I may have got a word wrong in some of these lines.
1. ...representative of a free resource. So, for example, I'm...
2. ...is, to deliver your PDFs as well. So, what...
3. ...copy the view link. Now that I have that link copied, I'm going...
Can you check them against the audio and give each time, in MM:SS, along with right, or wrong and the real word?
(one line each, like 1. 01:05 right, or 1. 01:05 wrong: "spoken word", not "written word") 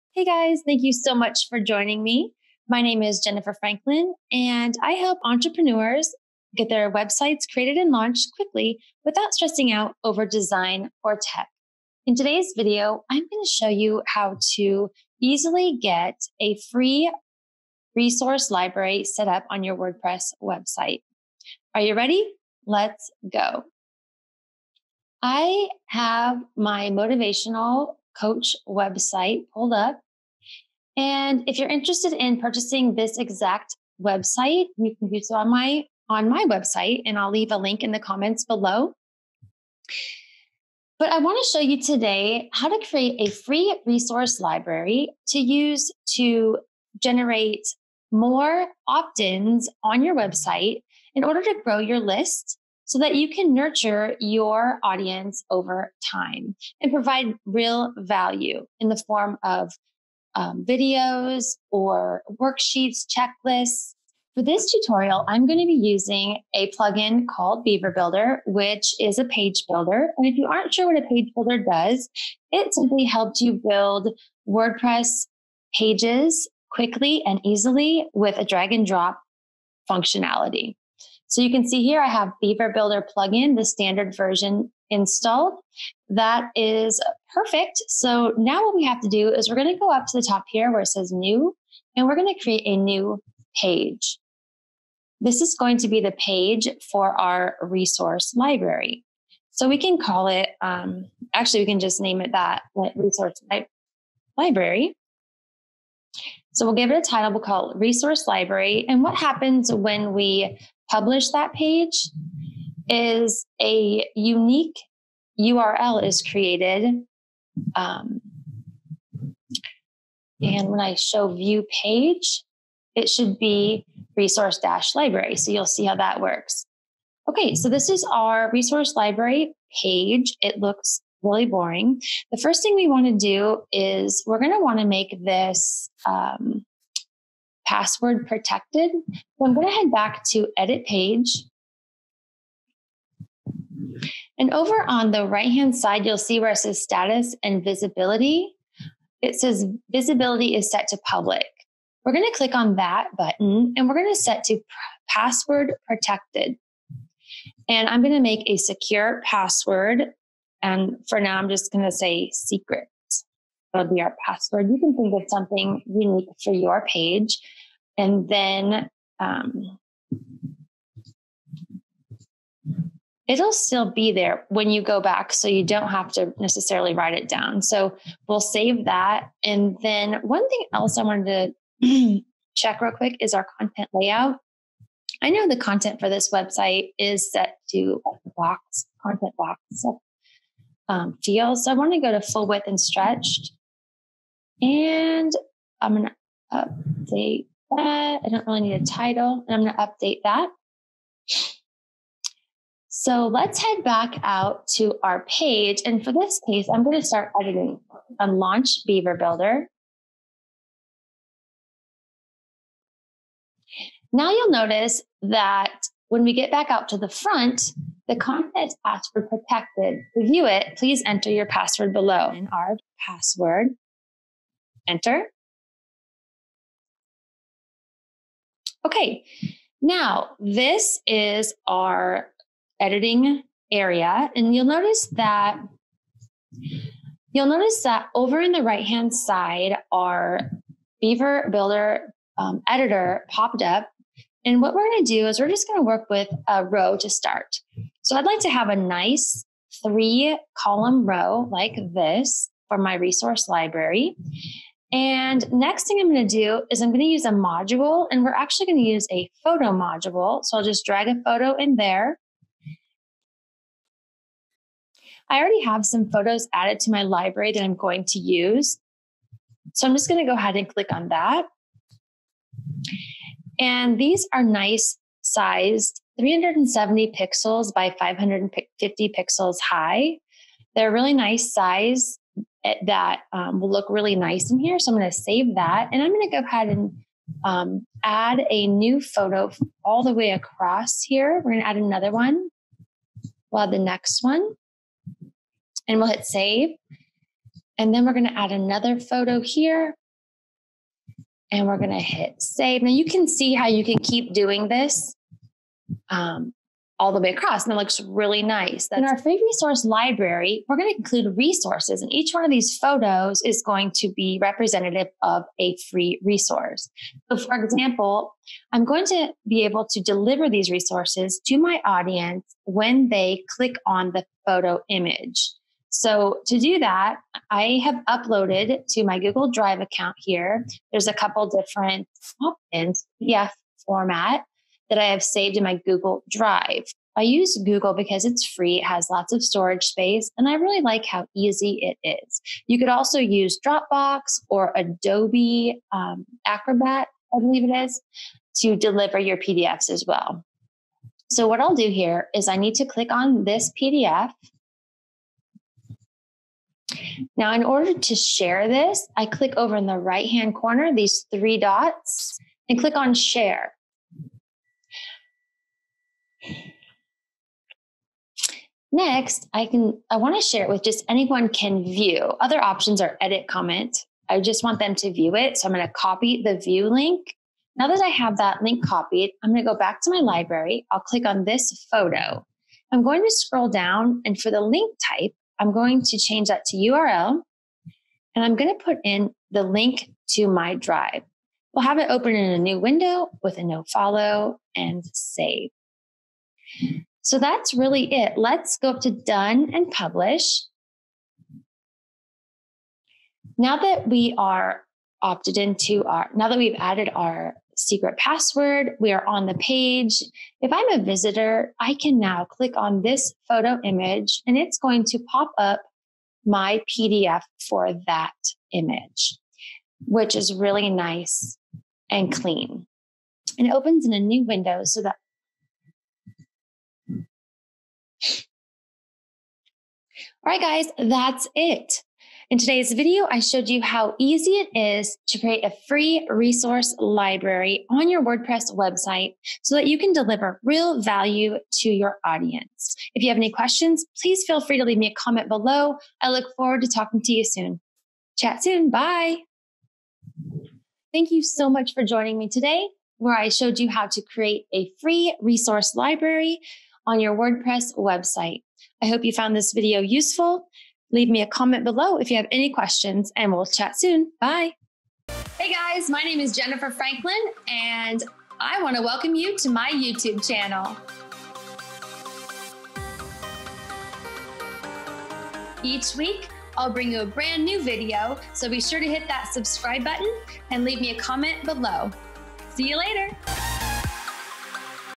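1. 05:14 right
2. 05:47 right
3. 06:15 right.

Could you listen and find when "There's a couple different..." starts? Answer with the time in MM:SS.
05:30.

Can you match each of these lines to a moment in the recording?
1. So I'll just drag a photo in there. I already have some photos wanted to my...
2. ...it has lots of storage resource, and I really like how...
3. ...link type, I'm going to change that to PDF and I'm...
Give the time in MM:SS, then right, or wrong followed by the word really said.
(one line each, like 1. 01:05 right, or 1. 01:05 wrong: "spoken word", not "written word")
1. 04:20 wrong: "added", not "wanted"
2. 05:38 wrong: "space", not "resource"
3. 06:24 wrong: "URL", not "PDF".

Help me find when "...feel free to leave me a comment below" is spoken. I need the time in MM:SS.
07:24.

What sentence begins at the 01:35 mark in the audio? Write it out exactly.
This is going to be the page for our resource library.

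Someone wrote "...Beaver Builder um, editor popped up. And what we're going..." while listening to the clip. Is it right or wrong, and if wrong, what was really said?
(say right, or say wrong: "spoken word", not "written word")
right.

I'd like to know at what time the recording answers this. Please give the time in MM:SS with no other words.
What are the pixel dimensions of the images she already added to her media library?
04:36.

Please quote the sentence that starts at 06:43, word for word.
Now that we are opted into our, now that we've added our secret password, we are on the page.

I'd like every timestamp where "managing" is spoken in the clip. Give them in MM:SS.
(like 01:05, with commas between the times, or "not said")
not said.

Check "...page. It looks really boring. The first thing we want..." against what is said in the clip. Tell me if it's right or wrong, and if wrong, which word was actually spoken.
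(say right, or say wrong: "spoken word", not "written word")
right.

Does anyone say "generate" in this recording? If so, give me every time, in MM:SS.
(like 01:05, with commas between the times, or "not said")
00:47.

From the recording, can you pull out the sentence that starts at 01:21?
So you can see here I have Beaver Builder plugin, the standard version installed.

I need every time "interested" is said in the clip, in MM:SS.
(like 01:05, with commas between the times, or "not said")
00:31.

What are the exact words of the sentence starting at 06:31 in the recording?
We'll have it open in a new window with a no follow and save.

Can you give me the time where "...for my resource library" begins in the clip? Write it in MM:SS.
04:12.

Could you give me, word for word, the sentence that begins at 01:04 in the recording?
For this tutorial, I'm going to be using a plugin called Beaver Builder, which is a page builder.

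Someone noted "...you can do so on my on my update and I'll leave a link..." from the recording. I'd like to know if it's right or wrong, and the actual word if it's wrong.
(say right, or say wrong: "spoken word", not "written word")
wrong: "website", not "update".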